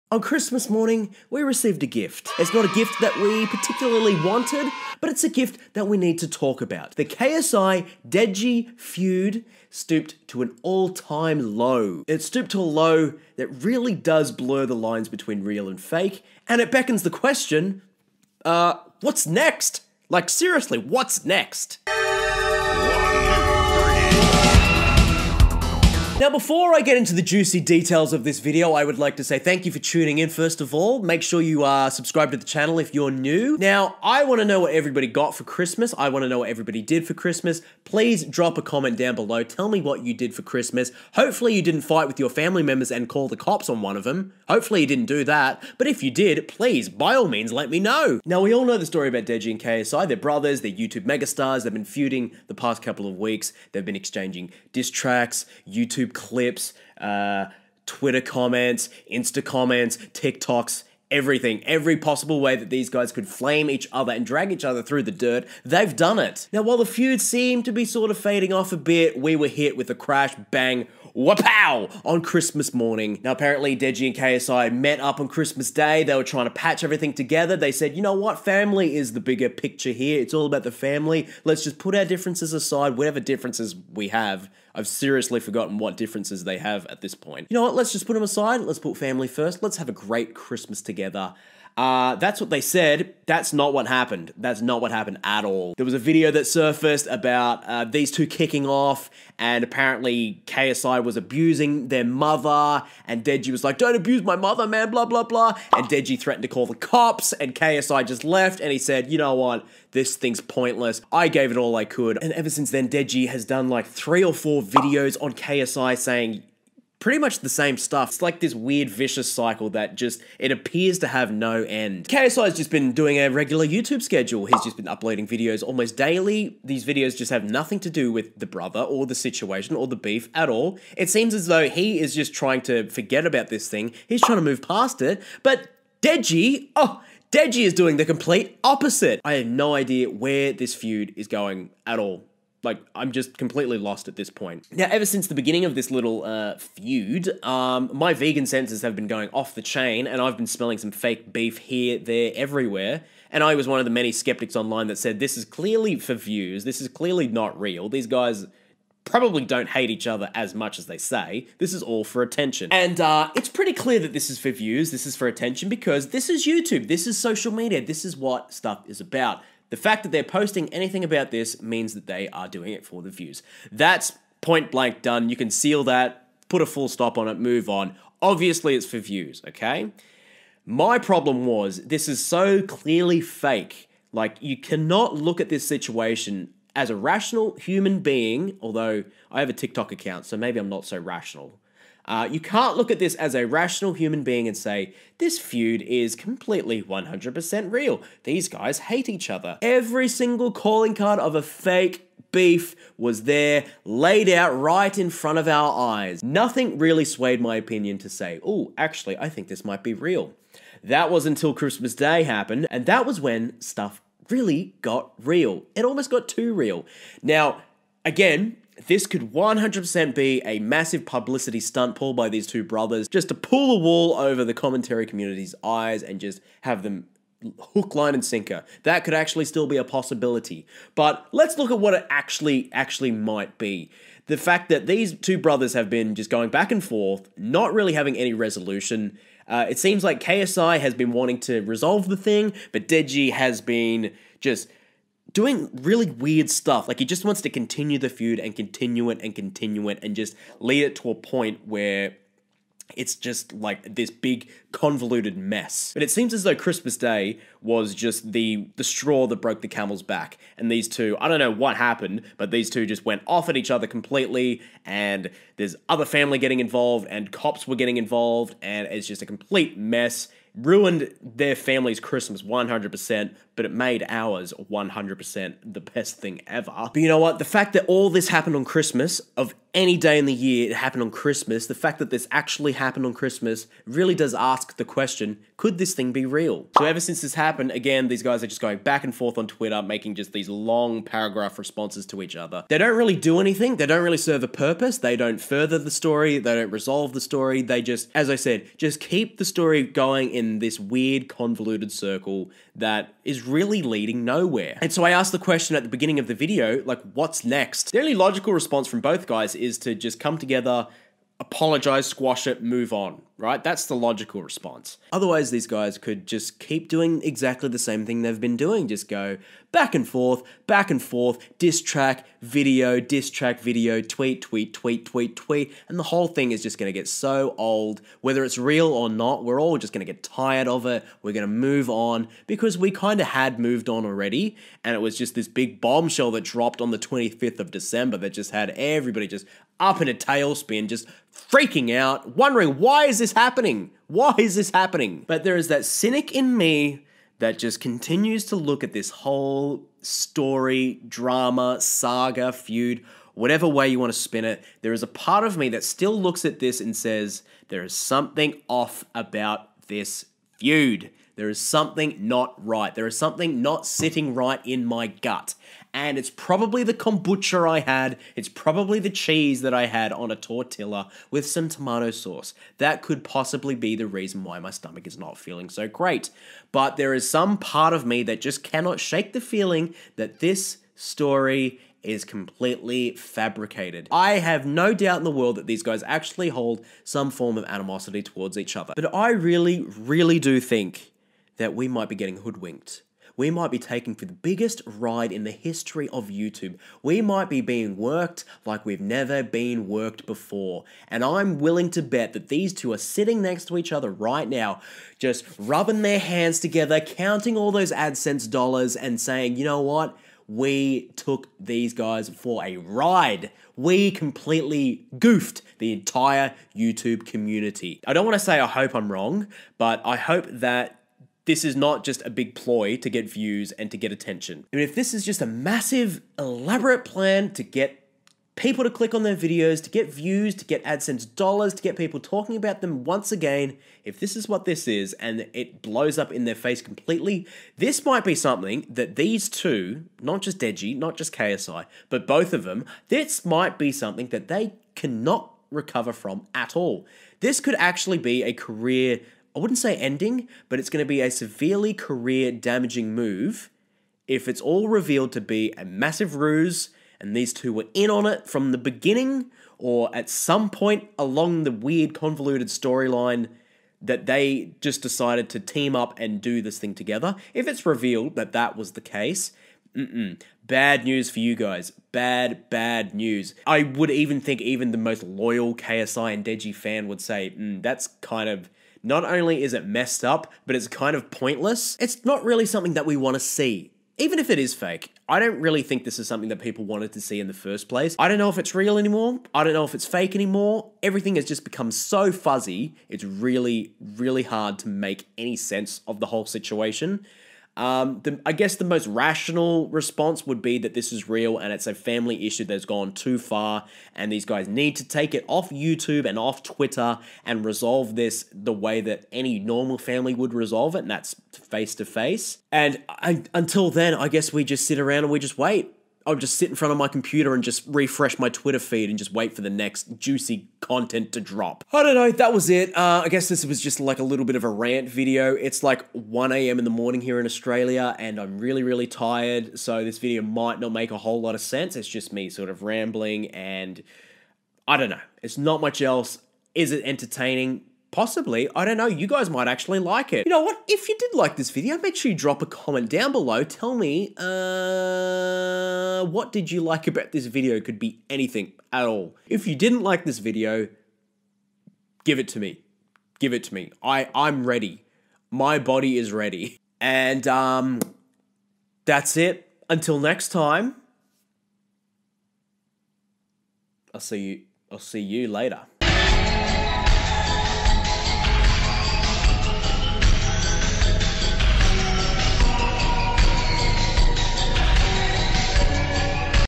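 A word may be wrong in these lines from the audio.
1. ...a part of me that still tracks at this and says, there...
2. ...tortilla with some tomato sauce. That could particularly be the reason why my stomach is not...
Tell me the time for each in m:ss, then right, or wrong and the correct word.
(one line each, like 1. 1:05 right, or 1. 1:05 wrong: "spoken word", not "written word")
1. 5:55 wrong: "looks", not "tracks"
2. 6:10 wrong: "possibly", not "particularly".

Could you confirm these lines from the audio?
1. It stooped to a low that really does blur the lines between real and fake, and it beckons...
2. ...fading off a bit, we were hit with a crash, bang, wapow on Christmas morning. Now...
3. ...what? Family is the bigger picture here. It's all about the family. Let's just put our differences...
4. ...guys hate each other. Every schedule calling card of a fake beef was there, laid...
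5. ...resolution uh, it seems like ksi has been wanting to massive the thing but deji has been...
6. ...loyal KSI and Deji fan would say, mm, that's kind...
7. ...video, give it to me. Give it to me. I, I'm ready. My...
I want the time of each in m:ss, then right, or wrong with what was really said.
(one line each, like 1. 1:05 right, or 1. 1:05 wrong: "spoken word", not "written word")
1. 0:12 right
2. 1:08 right
3. 1:18 right
4. 3:18 wrong: "single", not "schedule"
5. 3:58 wrong: "resolve", not "massive"
6. 7:55 right
7. 9:10 right.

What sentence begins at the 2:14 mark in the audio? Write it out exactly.
He's trying to move past it, but Deji, oh, Deji is doing the complete opposite.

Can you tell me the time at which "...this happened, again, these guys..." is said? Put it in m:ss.
4:47.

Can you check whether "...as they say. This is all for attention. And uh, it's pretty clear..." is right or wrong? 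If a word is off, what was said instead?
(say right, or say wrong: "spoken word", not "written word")
right.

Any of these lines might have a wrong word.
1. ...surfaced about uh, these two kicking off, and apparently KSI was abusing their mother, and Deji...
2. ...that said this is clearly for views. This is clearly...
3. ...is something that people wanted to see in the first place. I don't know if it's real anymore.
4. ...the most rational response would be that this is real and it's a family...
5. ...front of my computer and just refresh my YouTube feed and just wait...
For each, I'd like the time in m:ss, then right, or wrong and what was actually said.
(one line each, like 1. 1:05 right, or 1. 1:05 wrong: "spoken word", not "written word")
1. 1:36 right
2. 2:34 right
3. 8:06 right
4. 8:18 right
5. 8:36 wrong: "Twitter", not "YouTube".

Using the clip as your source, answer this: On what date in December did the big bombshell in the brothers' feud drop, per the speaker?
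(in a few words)
25th of December.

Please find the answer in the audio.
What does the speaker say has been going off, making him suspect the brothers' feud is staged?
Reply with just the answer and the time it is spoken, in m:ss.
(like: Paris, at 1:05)
Vegan senses, at 2:28.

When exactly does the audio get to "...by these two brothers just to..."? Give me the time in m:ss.
3:42.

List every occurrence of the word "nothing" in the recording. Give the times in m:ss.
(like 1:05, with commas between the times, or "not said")
2:07, 3:26.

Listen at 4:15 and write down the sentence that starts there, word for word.
But it seems as though Christmas Day was just the the straw that broke the camel's back.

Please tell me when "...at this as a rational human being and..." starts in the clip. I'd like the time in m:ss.
3:12.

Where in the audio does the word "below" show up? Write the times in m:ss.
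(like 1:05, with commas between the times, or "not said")
0:39, 9:03.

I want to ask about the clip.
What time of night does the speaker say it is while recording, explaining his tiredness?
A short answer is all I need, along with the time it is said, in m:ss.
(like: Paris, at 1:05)
1 a.m., at 8:46.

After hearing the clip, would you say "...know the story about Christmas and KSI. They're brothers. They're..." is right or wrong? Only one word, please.
wrong.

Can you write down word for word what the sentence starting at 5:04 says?
And so, I asked the question at the beginning of the video, like, what's next?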